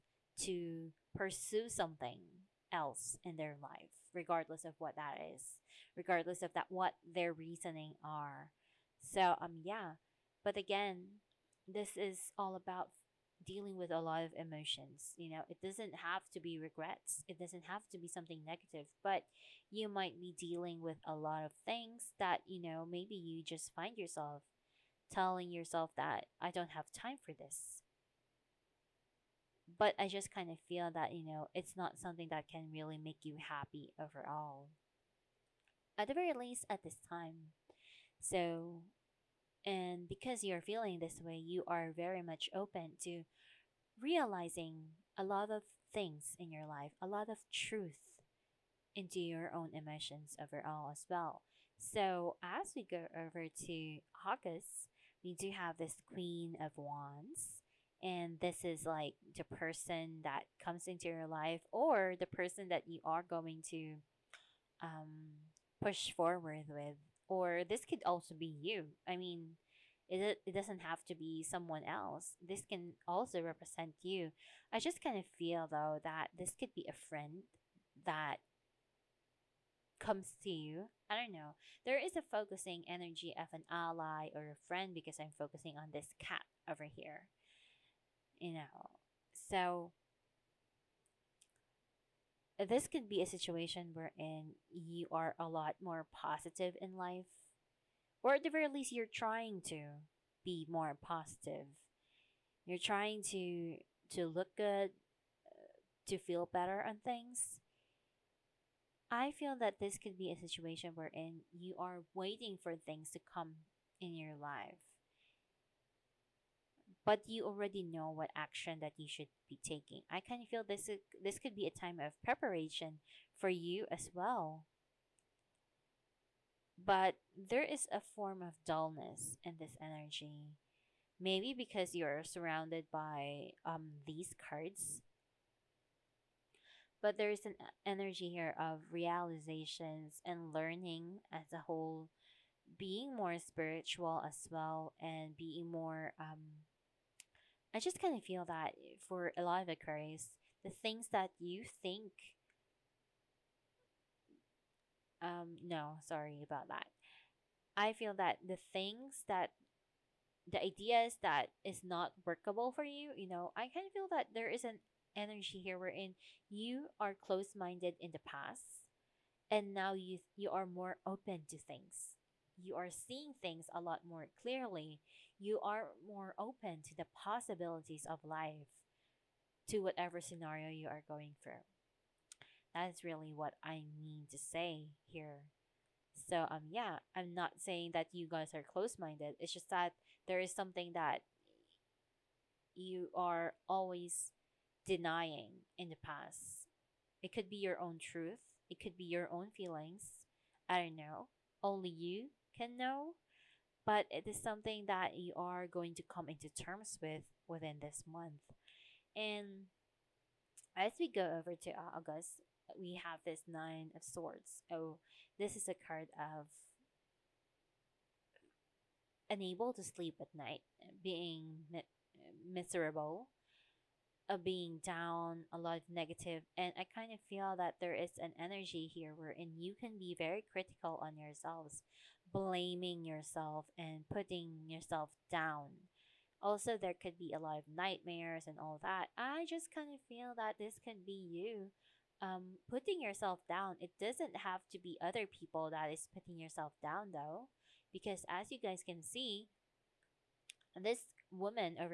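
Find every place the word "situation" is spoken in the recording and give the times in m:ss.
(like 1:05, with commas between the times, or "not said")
1:33, 1:50.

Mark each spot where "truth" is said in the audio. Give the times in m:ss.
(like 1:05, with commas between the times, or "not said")
0:47, 3:17.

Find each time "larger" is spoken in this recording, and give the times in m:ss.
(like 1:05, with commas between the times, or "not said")
not said.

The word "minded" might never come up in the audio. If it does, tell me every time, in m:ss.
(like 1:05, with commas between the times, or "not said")
2:47, 3:08.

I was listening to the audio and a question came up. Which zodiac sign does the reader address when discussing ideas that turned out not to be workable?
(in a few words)
Aquarius.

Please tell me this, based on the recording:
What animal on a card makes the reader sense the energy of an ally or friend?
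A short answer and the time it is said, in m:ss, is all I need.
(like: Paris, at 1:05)
cat, at 1:26.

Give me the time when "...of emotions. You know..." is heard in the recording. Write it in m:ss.
0:14.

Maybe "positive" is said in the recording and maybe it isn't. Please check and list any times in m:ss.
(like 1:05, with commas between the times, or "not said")
1:36, 1:40.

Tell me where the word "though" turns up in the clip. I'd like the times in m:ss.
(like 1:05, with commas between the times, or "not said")
1:15, 4:07.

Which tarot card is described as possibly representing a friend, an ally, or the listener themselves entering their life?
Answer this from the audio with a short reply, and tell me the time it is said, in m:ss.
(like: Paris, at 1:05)
Queen of Wands, at 0:55.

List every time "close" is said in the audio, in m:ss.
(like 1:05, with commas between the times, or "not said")
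2:47, 3:08.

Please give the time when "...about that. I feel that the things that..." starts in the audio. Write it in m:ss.
2:36.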